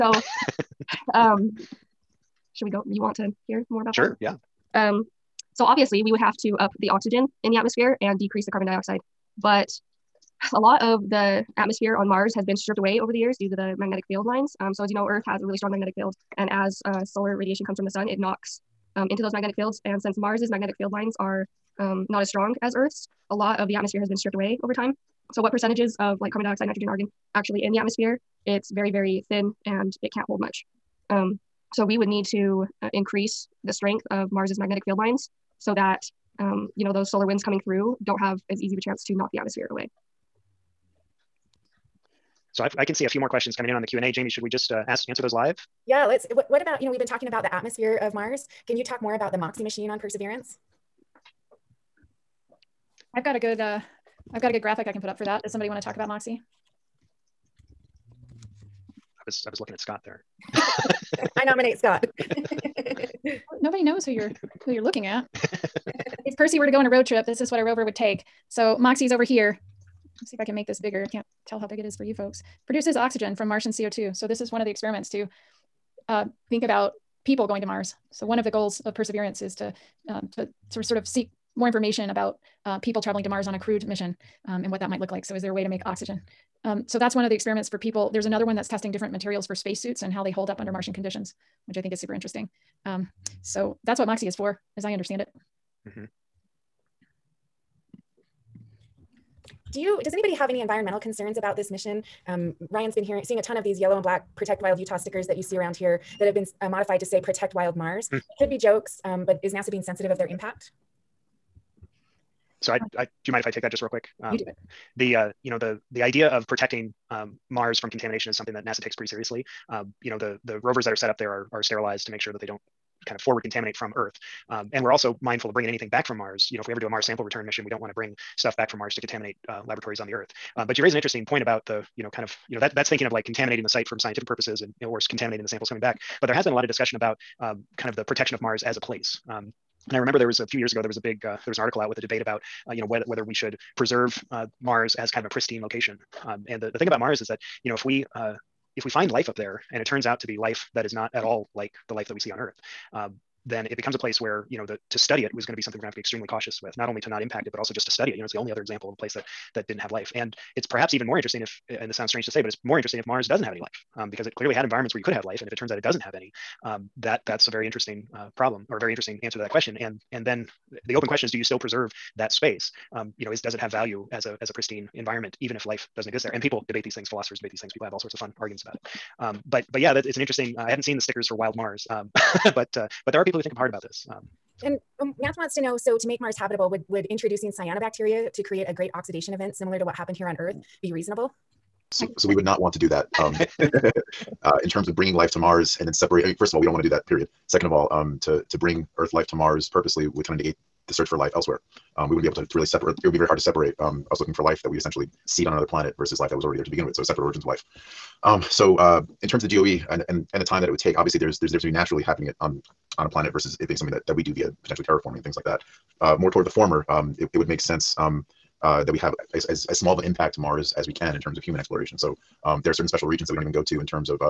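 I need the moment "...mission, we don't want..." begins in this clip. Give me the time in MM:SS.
02:07.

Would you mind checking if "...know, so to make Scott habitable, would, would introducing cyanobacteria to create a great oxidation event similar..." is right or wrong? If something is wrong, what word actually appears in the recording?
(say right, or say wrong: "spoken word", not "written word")
wrong: "Mars", not "Scott".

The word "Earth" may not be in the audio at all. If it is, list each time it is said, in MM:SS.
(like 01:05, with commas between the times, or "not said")
00:15, 00:22, 02:03, 02:10, 02:32, 03:10, 03:18.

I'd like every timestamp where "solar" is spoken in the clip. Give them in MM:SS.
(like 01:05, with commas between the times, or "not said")
00:17, 00:37.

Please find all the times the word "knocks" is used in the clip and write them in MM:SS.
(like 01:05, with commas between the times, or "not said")
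00:18, 00:39.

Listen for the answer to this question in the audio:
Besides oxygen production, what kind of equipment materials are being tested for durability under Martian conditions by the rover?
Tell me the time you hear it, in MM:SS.
01:29.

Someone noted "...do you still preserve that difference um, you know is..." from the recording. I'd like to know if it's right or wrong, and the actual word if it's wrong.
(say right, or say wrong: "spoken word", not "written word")
wrong: "space", not "difference".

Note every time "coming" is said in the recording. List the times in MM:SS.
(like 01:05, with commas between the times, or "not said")
00:37, 00:43, 02:15.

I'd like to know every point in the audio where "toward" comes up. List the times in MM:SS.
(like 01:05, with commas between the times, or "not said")
03:36.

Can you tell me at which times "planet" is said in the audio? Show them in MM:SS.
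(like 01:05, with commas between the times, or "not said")
03:25, 03:33.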